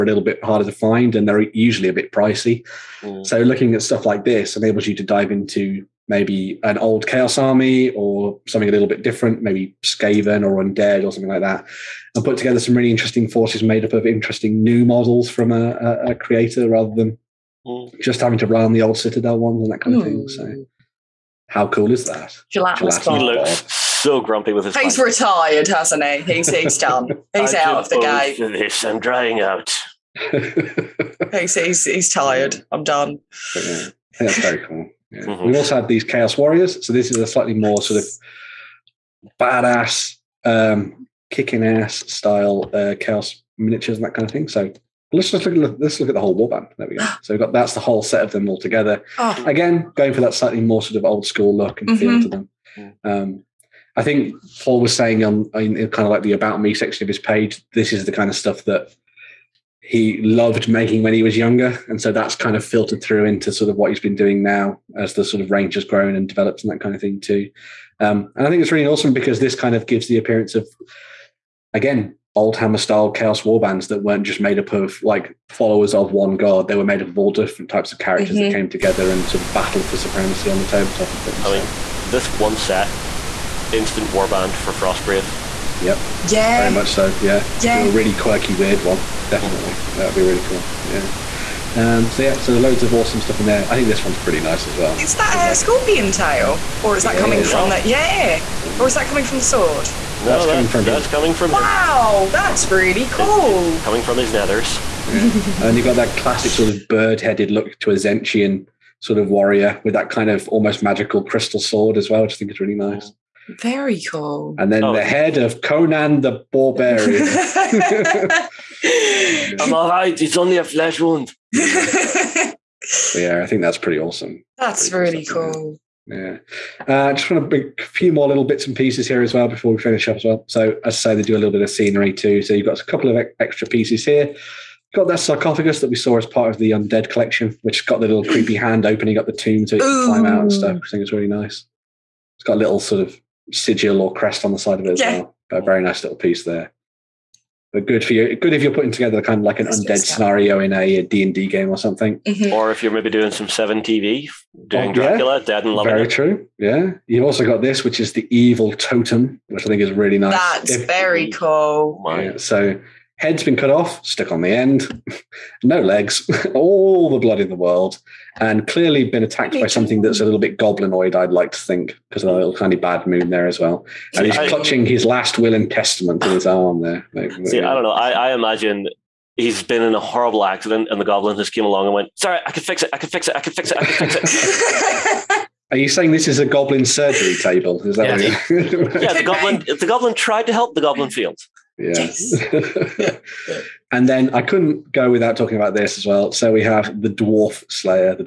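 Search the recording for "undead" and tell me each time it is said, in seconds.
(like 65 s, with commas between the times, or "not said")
10 s, 136 s, 149 s.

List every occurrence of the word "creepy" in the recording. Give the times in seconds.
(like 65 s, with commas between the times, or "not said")
138 s.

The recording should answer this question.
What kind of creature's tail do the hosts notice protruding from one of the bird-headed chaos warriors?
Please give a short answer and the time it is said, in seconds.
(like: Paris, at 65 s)
Scorpion, at 95 s.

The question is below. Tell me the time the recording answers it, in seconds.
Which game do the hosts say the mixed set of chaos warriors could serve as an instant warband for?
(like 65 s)
84 s.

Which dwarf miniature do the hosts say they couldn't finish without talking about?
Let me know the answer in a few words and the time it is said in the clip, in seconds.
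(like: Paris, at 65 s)
Dwarf Slayer, at 197 s.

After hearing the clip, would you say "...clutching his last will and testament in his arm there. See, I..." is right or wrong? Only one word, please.
right.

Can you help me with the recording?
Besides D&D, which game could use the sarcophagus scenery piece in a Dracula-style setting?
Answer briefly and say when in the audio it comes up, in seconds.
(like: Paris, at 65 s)
Seven TV, at 153 s.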